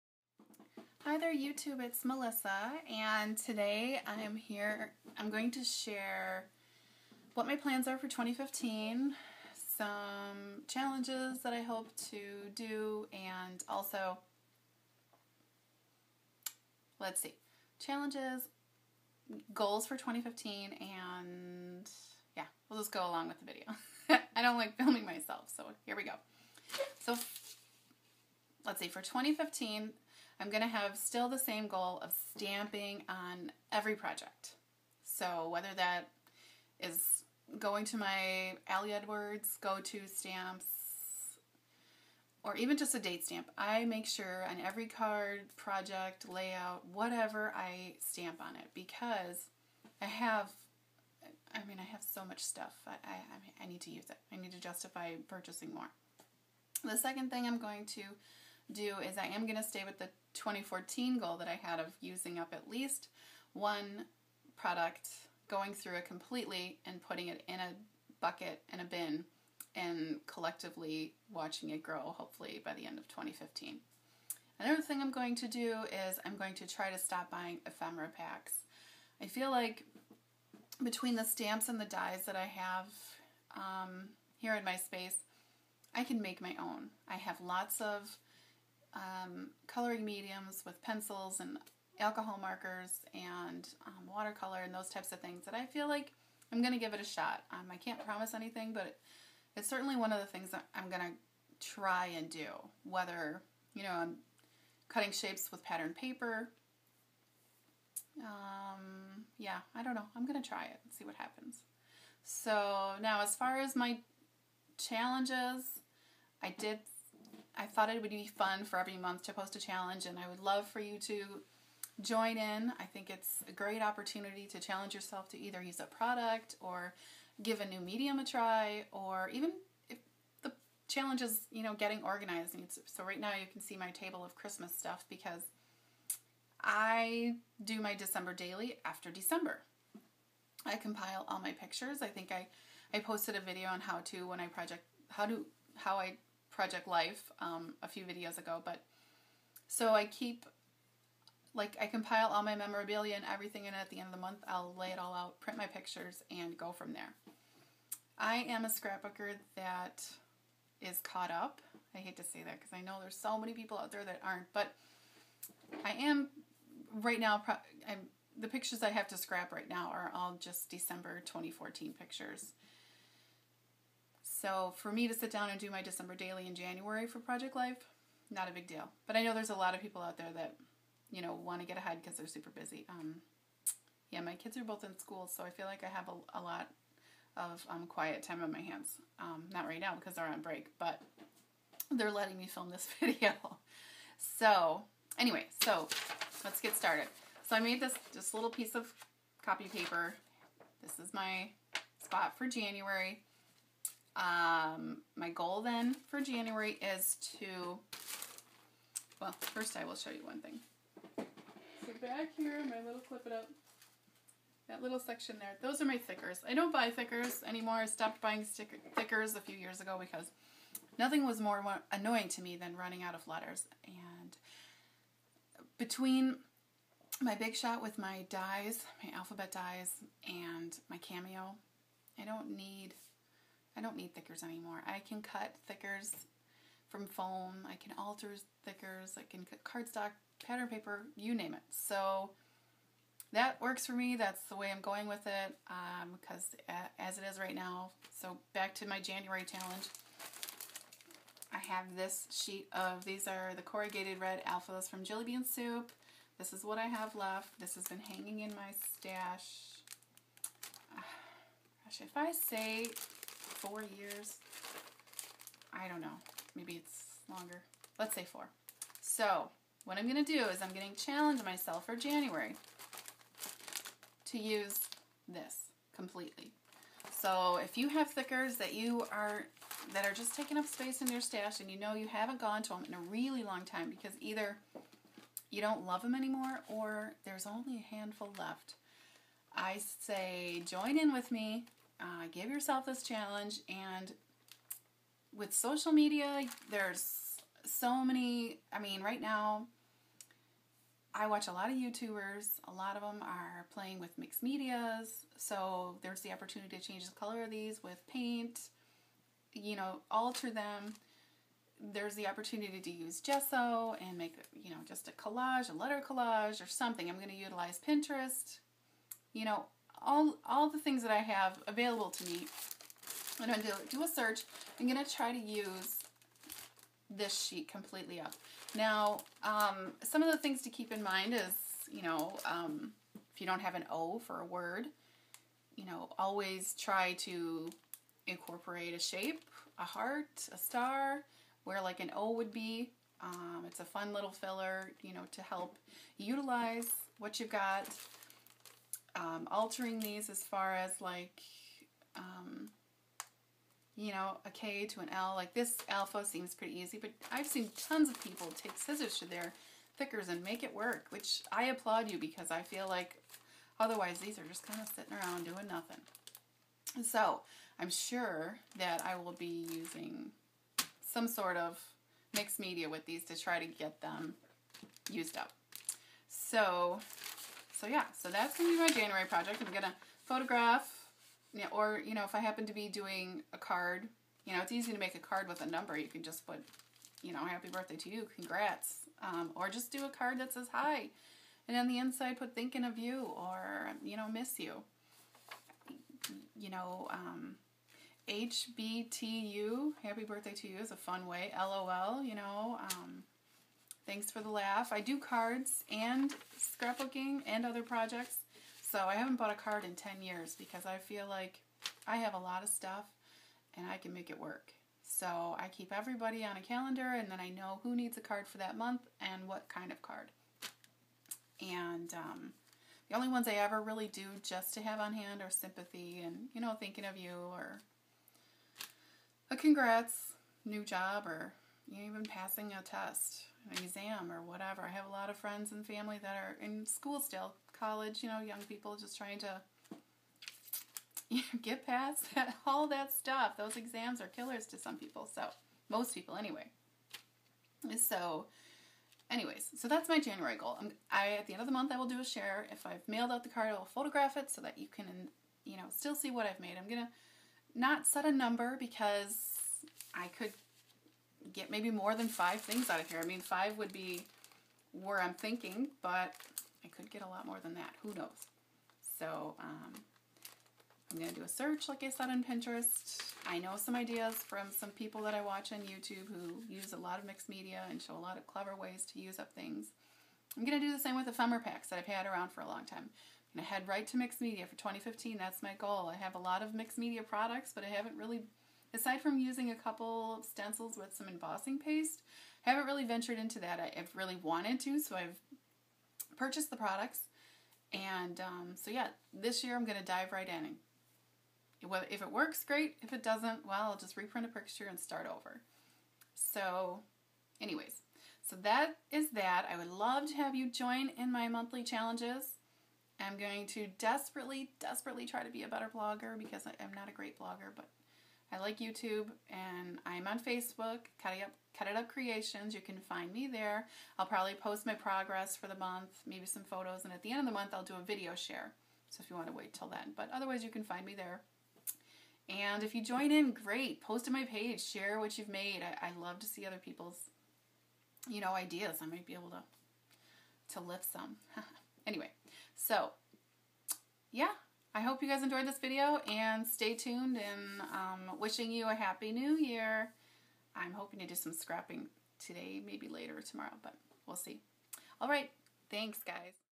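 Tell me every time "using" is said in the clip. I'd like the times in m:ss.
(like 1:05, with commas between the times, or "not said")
1:01, 6:09, 8:09.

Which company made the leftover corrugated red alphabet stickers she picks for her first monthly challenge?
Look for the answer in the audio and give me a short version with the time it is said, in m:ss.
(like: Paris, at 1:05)
Jillibean Soup, at 4:15.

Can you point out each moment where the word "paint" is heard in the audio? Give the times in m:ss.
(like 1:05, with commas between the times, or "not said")
5:08.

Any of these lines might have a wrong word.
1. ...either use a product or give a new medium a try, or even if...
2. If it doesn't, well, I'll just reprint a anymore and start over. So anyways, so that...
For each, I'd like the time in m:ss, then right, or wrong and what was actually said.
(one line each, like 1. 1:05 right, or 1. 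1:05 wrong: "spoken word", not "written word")
1. 2:05 right
2. 8:23 wrong: "picture", not "anymore".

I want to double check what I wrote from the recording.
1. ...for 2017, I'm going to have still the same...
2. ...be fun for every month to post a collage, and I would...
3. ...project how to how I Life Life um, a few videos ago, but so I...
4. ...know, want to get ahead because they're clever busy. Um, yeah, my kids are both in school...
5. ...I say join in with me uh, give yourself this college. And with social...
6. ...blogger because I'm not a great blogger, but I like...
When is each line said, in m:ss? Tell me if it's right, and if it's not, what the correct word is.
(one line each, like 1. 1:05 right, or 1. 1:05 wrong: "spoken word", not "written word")
1. 0:28 wrong: "2015", not "2017"
2. 1:58 wrong: "challenge", not "collage"
3. 2:24 wrong: "Project", not "Life"
4. 3:01 wrong: "super", not "clever"
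5. 4:49 wrong: "challenge", not "college"
6. 8:35 right.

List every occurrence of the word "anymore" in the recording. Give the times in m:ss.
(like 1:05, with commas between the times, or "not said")
3:37, 3:54, 4:46.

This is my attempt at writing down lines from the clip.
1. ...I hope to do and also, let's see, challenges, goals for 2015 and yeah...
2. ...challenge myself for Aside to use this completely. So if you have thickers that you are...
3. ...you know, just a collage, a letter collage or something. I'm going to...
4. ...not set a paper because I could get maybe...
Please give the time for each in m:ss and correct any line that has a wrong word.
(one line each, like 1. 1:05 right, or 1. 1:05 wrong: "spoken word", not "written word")
1. 0:11 right
2. 4:31 wrong: "January", not "Aside"
3. 5:14 right
4. 7:37 wrong: "number", not "paper".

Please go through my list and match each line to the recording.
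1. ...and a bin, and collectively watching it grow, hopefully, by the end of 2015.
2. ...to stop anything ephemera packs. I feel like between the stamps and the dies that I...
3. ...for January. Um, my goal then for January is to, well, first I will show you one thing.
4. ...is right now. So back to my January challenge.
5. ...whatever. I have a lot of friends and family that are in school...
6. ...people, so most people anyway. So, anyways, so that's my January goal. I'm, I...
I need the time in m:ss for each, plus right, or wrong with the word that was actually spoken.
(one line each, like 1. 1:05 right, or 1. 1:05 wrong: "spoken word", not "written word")
1. 1:08 right
2. 1:16 wrong: "buying", not "anything"
3. 3:22 right
4. 4:07 right
5. 7:14 right
6. 7:24 right.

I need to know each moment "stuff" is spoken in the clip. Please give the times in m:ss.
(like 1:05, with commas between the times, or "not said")
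0:52, 2:14, 6:52, 7:23.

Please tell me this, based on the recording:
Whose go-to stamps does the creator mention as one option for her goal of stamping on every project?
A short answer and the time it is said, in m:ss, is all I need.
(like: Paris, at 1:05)
Ali Edwards, at 0:38.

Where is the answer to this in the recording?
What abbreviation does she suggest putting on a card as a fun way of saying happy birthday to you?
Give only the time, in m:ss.
6:38.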